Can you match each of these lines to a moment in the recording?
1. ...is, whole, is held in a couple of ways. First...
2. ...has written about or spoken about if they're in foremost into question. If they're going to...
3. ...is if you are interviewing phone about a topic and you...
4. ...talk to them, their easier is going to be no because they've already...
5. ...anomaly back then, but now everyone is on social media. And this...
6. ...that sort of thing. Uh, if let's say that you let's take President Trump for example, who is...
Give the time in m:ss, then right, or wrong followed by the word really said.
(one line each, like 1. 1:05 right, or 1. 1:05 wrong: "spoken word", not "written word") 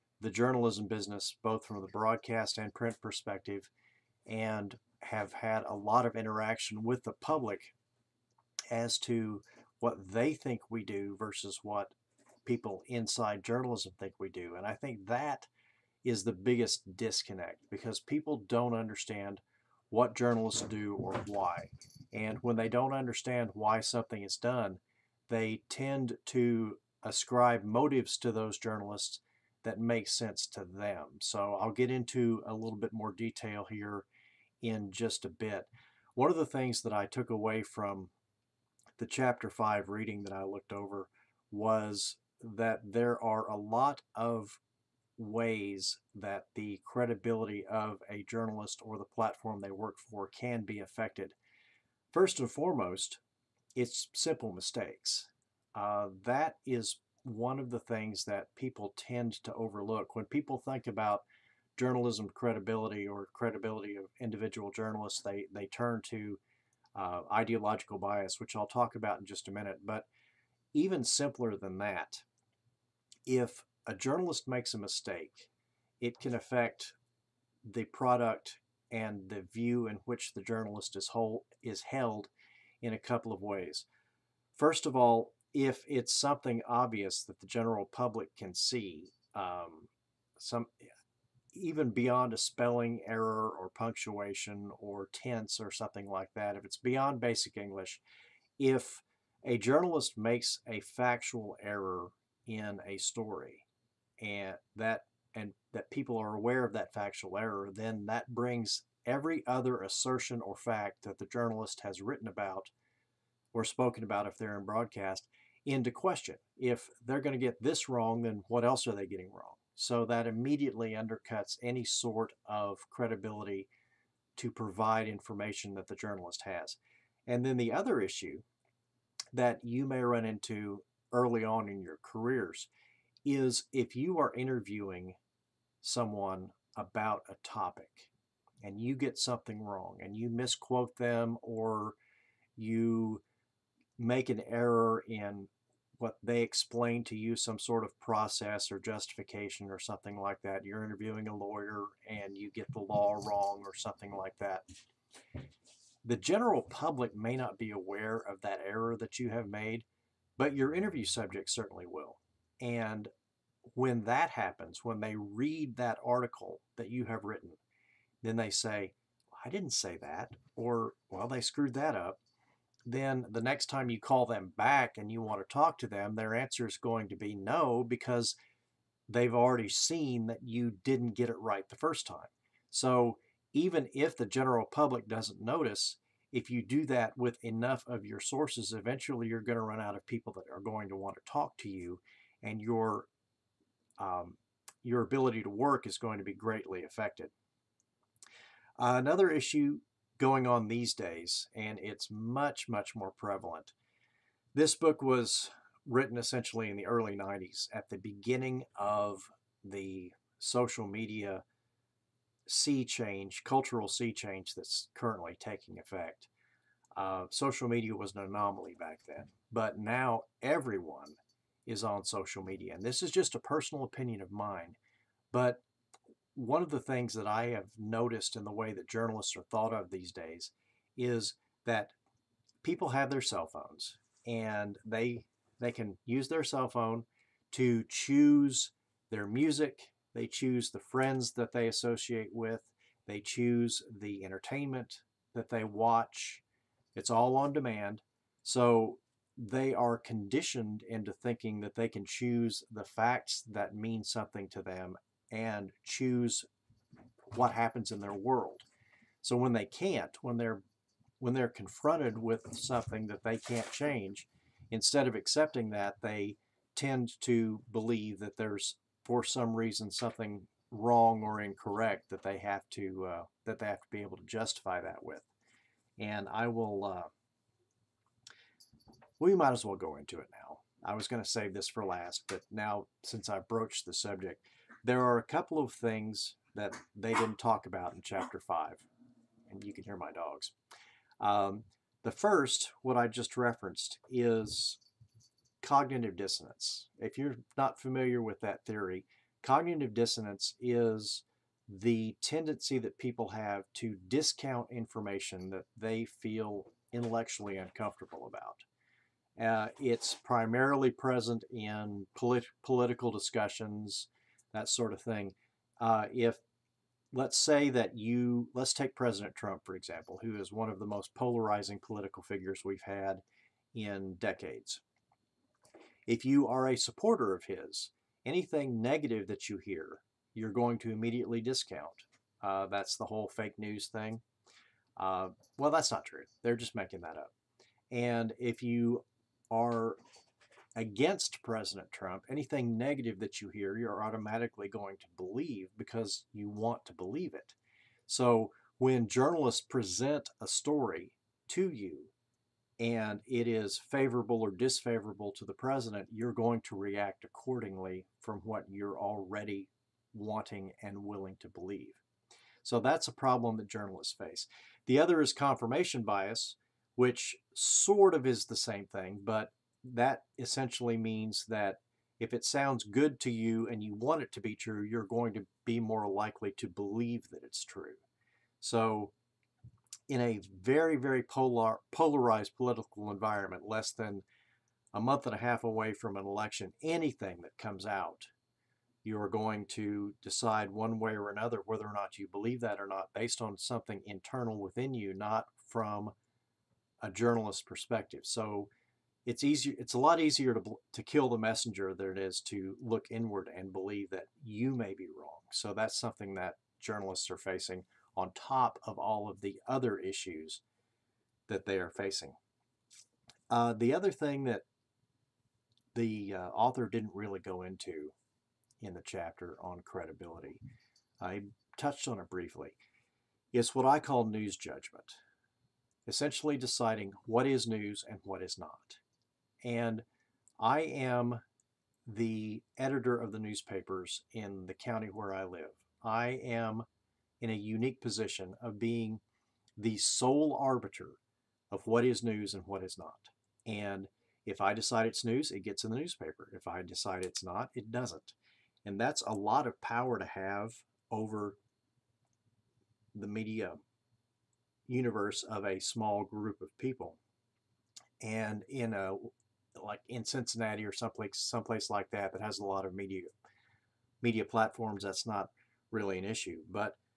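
1. 1:20 right
2. 1:51 wrong: "broadcast", not "foremost"
3. 2:13 wrong: "someone", not "phone"
4. 2:55 wrong: "answer", not "easier"
5. 3:38 right
6. 5:14 right.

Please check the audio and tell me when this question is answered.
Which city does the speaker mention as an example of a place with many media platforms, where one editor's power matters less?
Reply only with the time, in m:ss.
7:40.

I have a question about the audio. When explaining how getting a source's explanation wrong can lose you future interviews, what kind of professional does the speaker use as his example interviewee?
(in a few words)
A lawyer.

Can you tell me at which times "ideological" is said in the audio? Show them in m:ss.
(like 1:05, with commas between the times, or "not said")
1:07.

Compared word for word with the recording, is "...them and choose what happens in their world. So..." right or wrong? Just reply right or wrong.
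right.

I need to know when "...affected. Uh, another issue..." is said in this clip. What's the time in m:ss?
3:16.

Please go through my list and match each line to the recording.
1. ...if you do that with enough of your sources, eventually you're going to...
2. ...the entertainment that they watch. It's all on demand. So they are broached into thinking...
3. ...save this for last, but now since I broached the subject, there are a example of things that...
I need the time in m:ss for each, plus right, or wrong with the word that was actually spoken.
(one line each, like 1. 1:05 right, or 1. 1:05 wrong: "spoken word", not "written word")
1. 3:06 right
2. 4:04 wrong: "conditioned", not "broached"
3. 4:41 wrong: "couple", not "example".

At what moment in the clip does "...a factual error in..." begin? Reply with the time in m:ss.
1:40.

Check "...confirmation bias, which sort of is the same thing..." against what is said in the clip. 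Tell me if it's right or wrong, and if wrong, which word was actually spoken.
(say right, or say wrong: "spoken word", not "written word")
right.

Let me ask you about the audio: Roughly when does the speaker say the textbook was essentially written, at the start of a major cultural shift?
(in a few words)
Early 90s.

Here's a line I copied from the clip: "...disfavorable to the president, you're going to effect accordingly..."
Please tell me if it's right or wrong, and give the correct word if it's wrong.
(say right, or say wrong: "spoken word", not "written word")
wrong: "react", not "effect".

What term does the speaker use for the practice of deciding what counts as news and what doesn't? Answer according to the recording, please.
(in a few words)
News judgment.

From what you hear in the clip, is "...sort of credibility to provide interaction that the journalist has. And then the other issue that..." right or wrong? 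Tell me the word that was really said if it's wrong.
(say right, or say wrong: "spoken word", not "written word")
wrong: "information", not "interaction".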